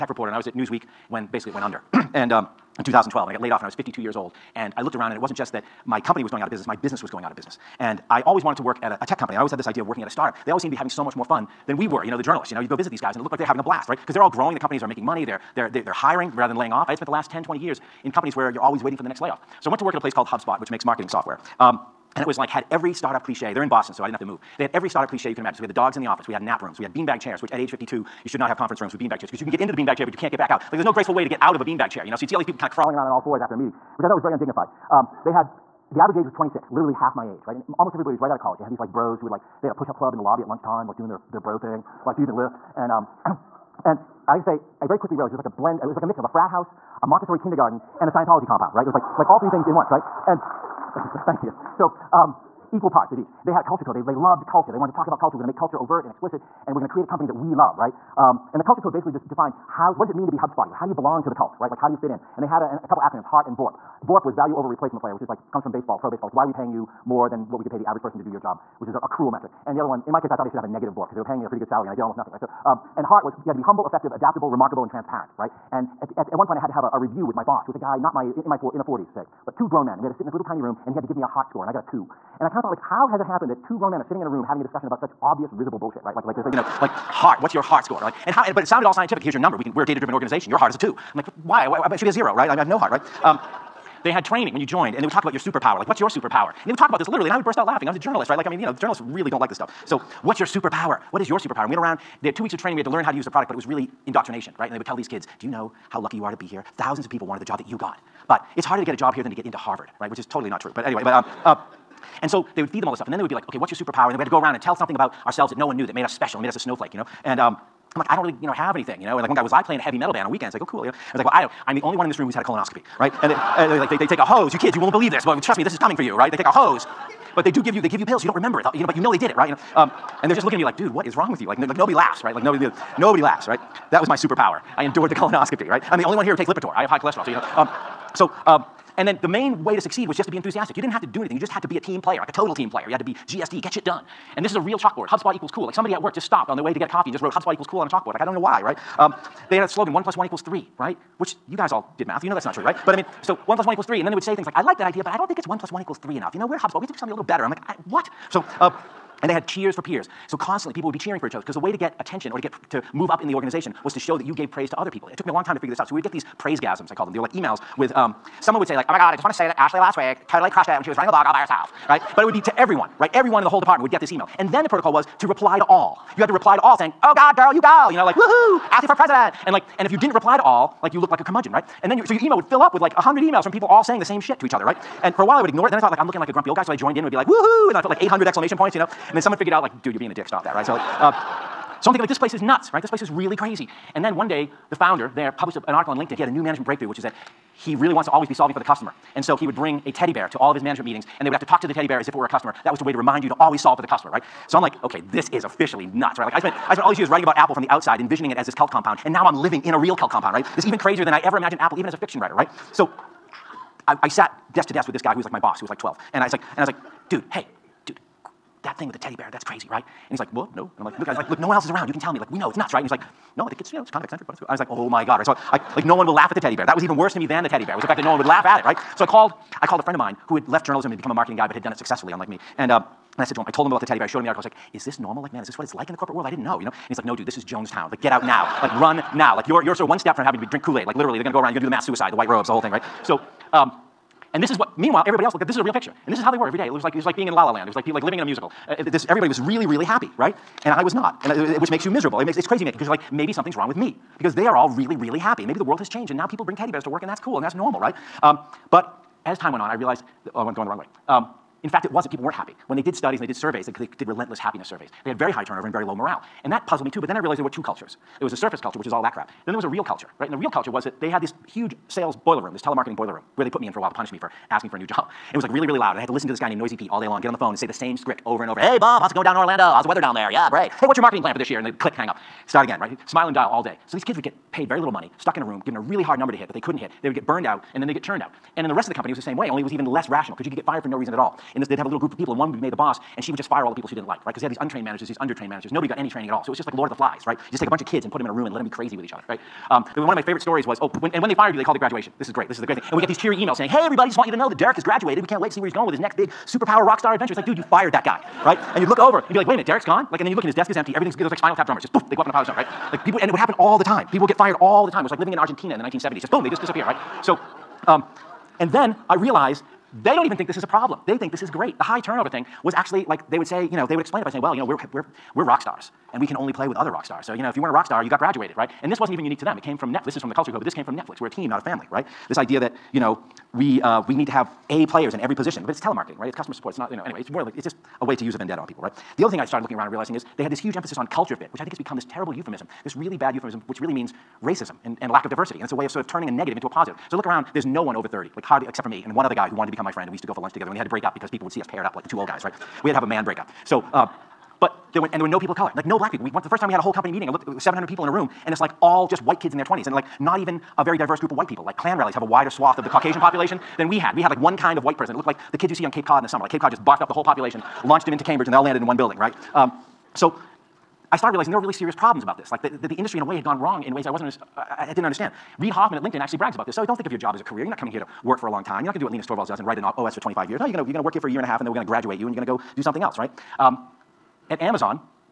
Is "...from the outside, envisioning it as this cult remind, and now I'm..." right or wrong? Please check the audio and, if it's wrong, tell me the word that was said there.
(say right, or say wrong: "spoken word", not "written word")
wrong: "compound", not "remind".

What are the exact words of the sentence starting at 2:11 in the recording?
Like, no, like nobody laughs, right?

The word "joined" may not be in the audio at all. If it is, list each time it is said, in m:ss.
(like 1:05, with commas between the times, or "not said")
1:34, 3:06.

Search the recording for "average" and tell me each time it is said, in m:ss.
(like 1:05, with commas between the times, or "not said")
0:35, 1:07.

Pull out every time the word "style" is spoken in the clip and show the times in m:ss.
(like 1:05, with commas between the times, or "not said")
not said.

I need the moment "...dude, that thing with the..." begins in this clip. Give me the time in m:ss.
3:37.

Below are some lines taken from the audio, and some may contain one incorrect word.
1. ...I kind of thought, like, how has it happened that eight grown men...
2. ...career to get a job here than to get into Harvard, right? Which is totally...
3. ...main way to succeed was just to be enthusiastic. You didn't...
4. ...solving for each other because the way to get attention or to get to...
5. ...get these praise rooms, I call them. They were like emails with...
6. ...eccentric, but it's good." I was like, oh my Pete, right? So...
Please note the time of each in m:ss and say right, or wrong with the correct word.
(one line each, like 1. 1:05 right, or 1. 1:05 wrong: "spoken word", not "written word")
1. 1:22 wrong: "two", not "eight"
2. 1:48 wrong: "harder", not "career"
3. 2:19 right
4. 2:40 wrong: "cheering", not "solving"
5. 2:46 wrong: "gasms", not "rooms"
6. 3:44 wrong: "God", not "Pete".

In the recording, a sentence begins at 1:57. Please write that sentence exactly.
And um, I'm like, I don't really, you know, have anything, you know?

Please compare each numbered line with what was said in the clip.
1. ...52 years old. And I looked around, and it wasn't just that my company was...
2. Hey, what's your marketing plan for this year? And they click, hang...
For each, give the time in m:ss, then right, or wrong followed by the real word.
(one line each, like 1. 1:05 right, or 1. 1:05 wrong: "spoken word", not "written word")
1. 0:03 right
2. 4:40 right.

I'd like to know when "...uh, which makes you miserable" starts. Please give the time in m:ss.
4:11.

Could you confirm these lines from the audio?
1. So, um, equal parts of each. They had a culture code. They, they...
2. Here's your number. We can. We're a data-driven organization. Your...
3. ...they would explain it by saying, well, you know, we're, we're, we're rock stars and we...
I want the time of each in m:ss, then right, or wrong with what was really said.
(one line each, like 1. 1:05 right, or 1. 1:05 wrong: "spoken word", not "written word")
1. 0:51 right
2. 1:29 right
3. 5:23 right.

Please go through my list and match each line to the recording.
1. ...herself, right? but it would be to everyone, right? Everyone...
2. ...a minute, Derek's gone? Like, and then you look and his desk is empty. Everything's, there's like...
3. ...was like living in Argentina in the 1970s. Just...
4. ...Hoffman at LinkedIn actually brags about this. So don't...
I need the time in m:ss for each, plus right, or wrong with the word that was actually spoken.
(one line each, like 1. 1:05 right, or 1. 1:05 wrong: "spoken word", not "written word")
1. 2:51 right
2. 5:09 right
3. 5:15 right
4. 6:15 right.